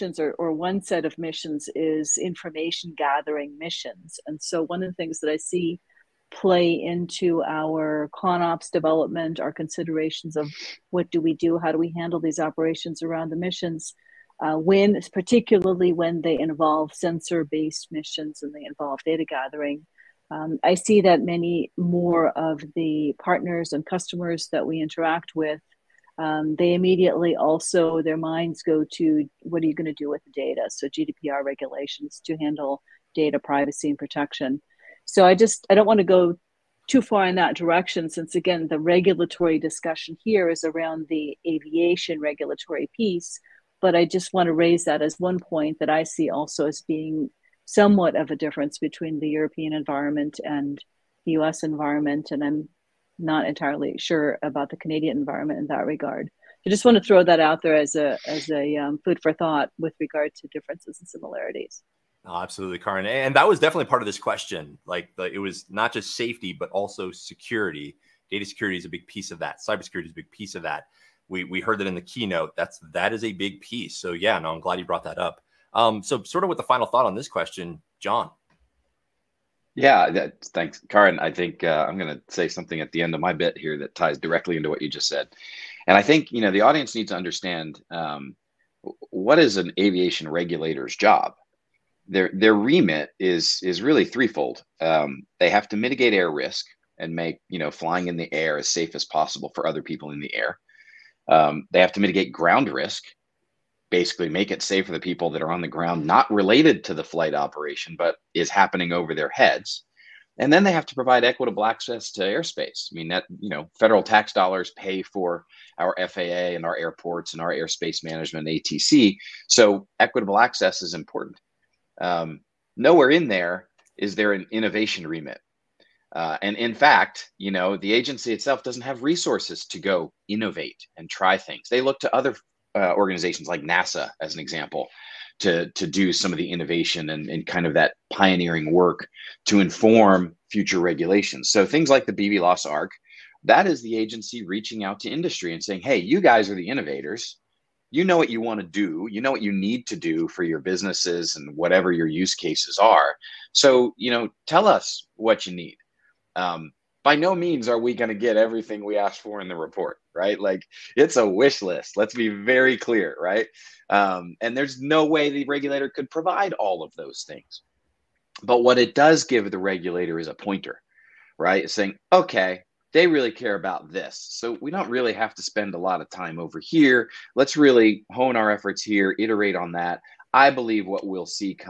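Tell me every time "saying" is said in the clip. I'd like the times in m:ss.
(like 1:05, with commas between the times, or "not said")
2:25, 2:51.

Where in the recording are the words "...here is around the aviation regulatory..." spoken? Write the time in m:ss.
0:40.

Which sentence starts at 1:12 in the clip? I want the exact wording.
That's that is a big piece.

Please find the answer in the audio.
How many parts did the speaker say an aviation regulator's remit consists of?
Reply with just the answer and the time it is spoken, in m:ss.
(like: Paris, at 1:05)
3, at 1:34.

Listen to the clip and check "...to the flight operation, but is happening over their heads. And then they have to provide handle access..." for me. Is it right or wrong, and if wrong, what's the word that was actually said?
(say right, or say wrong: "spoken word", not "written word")
wrong: "equitable", not "handle".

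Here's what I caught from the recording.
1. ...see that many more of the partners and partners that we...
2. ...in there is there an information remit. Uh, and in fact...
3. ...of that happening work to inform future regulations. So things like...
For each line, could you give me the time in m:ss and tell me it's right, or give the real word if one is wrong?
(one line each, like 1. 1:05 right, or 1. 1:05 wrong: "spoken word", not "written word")
1. 0:20 wrong: "customers", not "partners"
2. 2:03 wrong: "innovation", not "information"
3. 2:17 wrong: "pioneering", not "happening".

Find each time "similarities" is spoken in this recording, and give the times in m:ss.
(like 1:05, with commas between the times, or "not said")
1:01.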